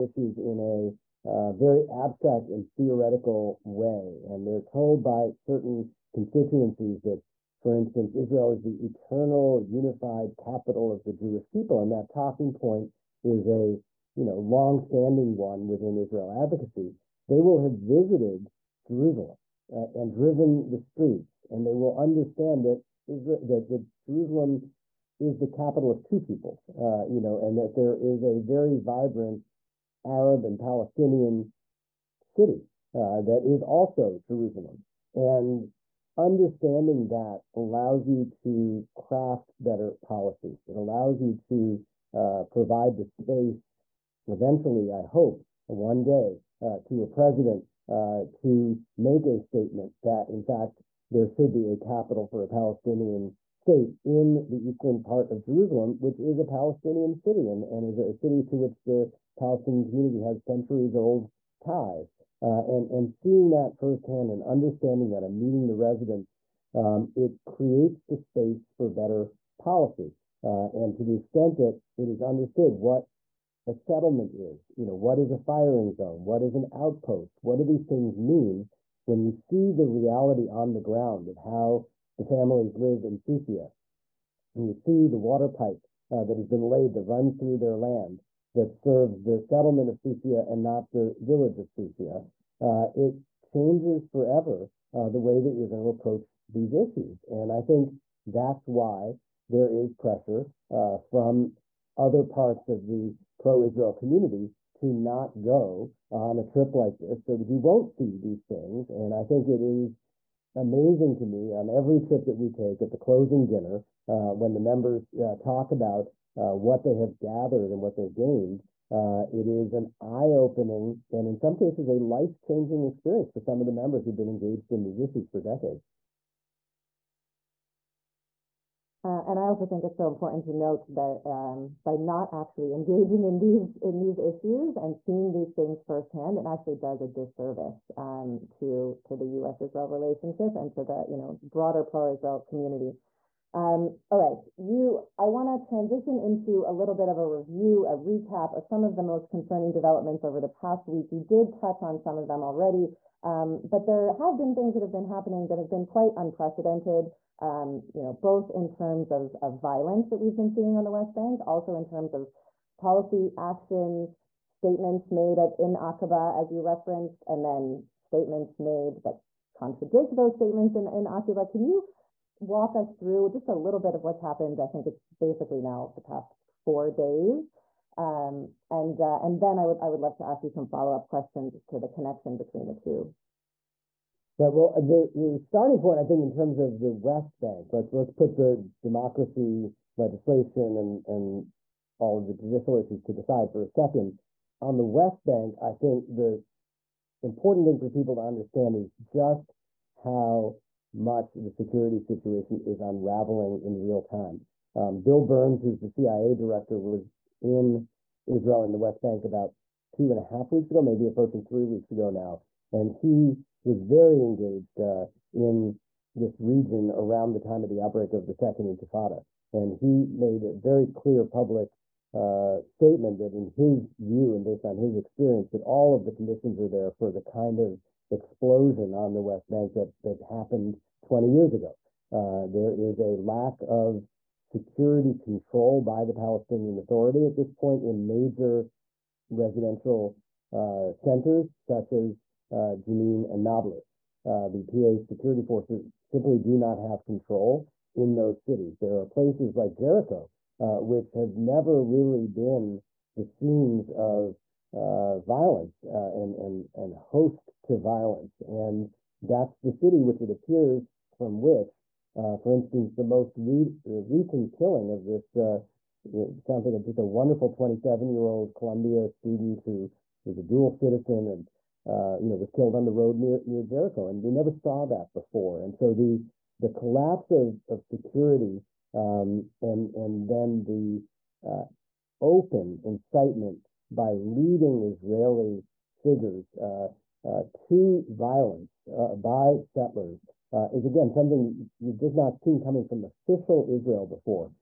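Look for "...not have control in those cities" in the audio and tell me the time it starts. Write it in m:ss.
4:06.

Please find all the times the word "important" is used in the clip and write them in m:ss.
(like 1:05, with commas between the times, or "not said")
2:10, 3:17.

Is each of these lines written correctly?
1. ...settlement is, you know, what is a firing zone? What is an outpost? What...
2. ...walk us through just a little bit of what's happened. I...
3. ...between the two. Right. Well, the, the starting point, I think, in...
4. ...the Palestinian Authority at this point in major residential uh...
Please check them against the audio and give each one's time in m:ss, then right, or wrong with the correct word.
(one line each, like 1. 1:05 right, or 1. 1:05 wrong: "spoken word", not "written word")
1. 1:13 right
2. 2:52 right
3. 3:02 right
4. 3:56 right.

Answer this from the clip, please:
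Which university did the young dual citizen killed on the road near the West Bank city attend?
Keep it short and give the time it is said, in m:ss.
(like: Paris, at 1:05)
Columbia, at 4:28.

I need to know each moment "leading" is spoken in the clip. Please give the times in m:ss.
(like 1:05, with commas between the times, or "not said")
4:44.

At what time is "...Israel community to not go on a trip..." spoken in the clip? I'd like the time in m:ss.
1:43.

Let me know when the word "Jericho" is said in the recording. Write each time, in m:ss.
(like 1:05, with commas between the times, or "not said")
4:09, 4:33.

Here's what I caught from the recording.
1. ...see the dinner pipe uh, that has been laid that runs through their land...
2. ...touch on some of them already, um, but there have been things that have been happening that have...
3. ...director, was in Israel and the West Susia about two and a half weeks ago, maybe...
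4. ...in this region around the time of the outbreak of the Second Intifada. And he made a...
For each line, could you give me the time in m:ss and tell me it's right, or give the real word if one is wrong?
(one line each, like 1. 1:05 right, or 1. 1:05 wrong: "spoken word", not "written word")
1. 1:24 wrong: "water", not "dinner"
2. 2:31 right
3. 3:26 wrong: "Bank", not "Susia"
4. 3:35 right.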